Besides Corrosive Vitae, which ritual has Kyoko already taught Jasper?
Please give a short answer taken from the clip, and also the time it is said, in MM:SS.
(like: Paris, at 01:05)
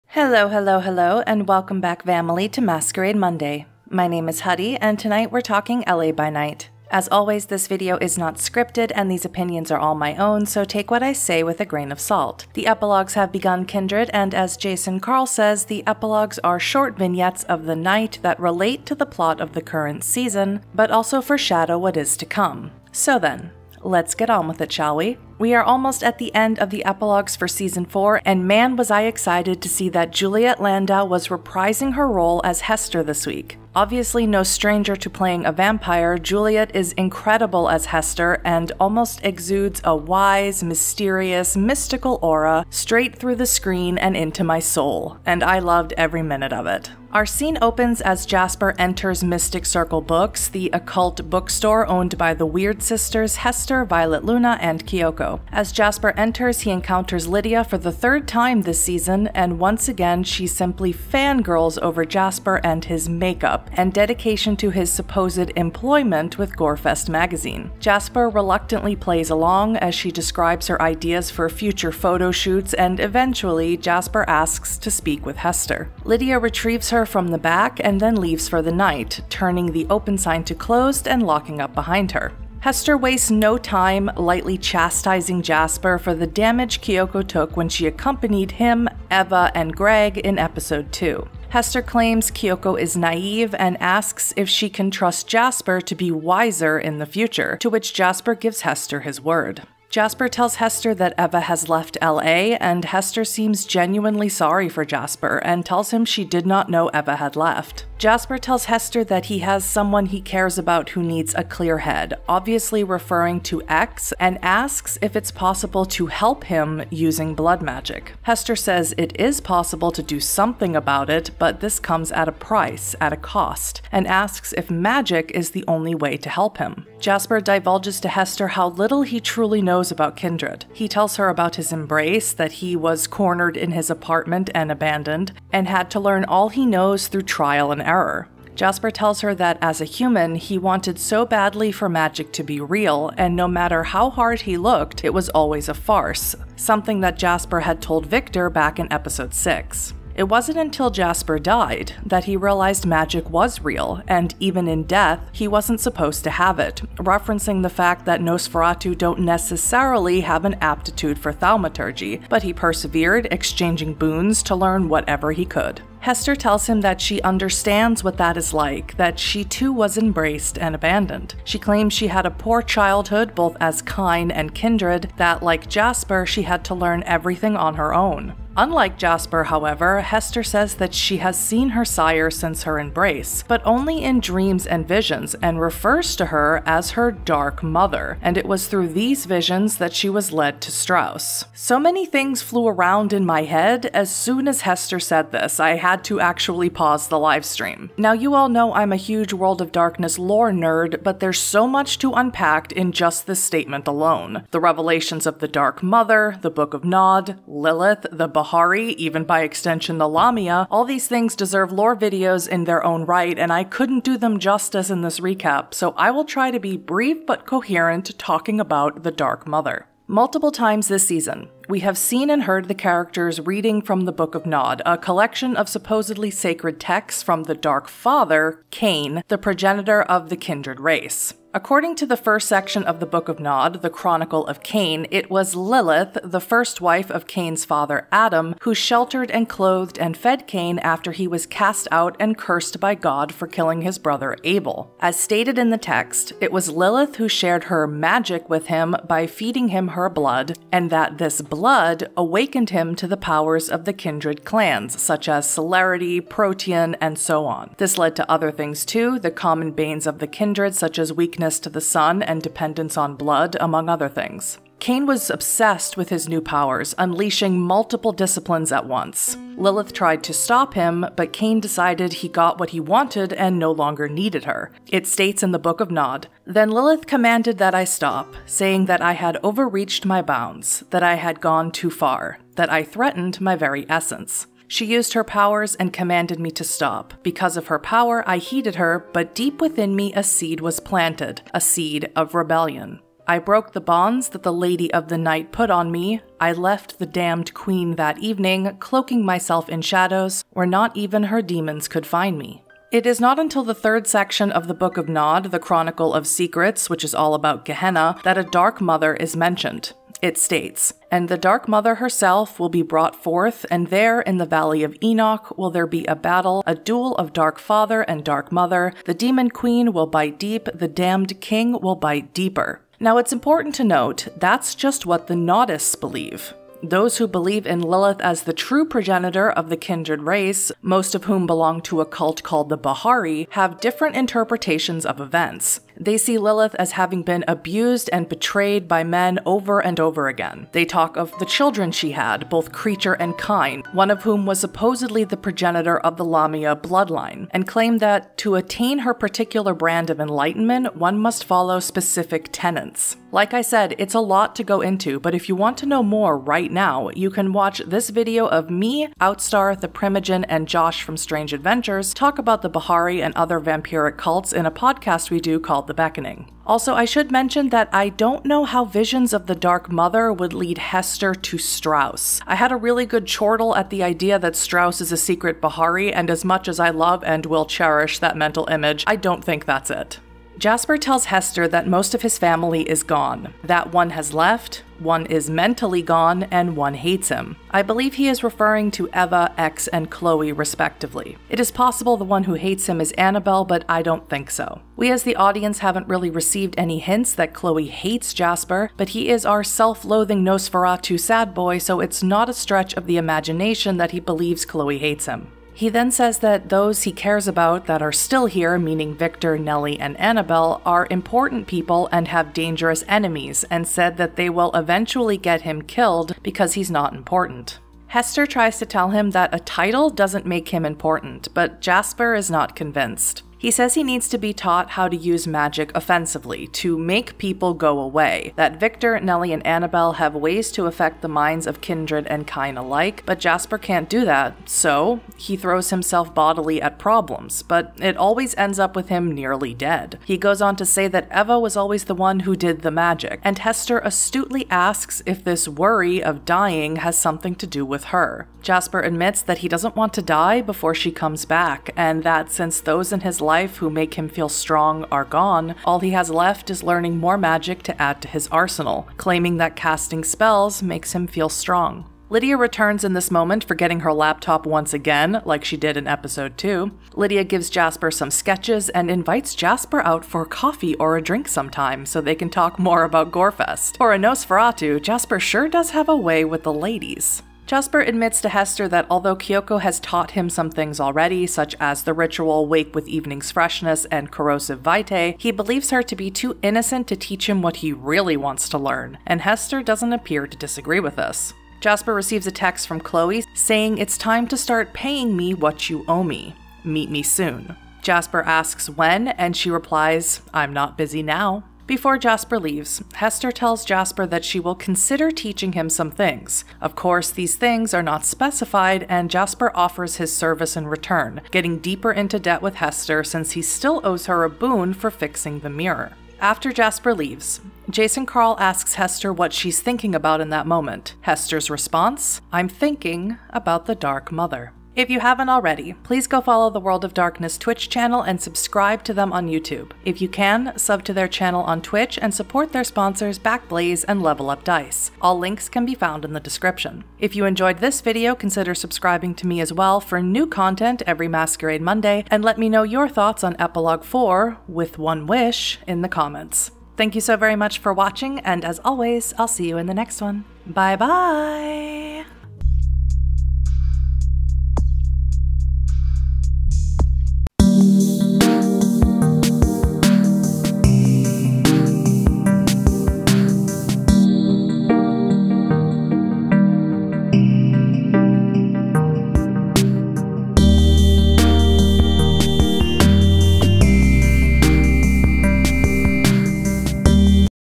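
Wake with Evening's Freshness, at 08:02.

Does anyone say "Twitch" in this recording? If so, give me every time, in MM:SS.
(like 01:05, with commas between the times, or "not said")
08:47, 08:51.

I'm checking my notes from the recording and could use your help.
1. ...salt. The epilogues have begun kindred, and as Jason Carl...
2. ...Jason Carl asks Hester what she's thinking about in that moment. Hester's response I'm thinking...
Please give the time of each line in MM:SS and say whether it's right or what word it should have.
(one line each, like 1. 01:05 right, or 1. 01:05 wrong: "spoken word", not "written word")
1. 00:12 right
2. 08:37 right.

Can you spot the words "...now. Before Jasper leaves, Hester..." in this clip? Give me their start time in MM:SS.
08:21.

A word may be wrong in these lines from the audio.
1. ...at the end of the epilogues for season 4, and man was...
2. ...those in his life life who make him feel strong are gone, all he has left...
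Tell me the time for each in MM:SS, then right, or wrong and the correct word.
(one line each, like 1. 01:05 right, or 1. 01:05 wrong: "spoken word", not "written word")
1. 00:26 right
2. 07:32 right.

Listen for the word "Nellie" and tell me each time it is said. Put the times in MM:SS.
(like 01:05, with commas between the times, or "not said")
06:49, 07:09.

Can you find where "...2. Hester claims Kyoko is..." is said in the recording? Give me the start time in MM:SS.
01:30.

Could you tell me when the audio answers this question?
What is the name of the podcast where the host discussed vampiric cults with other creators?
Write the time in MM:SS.
06:05.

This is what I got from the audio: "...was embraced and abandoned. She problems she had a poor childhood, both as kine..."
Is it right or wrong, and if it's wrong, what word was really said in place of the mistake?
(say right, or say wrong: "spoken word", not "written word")
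wrong: "claims", not "problems".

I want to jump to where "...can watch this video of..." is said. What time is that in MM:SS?
05:57.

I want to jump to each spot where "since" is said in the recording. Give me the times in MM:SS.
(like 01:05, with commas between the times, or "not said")
03:02, 07:32, 08:33.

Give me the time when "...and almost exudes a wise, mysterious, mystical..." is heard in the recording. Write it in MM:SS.
00:38.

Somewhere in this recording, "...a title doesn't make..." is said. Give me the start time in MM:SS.
06:59.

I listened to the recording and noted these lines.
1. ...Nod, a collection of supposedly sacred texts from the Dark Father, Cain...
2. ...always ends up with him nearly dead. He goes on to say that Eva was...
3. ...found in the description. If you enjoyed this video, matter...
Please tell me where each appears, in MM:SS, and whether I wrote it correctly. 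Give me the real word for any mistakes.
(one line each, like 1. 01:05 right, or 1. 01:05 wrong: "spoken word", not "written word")
1. 03:44 right
2. 07:18 right
3. 08:55 wrong: "consider", not "matter".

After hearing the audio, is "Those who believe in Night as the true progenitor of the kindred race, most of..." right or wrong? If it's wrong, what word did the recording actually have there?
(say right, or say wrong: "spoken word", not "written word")
wrong: "Lilith", not "Night".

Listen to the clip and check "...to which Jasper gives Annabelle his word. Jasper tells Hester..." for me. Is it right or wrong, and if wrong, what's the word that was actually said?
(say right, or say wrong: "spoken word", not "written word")
wrong: "Hester", not "Annabelle".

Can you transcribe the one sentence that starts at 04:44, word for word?
She used her powers and commanded me to stop.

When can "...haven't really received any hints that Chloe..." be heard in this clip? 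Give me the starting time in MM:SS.
06:35.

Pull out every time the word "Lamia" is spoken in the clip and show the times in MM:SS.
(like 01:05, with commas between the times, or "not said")
03:30, 05:46.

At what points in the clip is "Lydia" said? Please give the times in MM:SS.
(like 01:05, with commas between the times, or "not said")
00:57, 01:16, 07:42, 07:47.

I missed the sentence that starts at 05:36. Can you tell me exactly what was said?
They see Lilith as having been abused and betrayed by men over and over again.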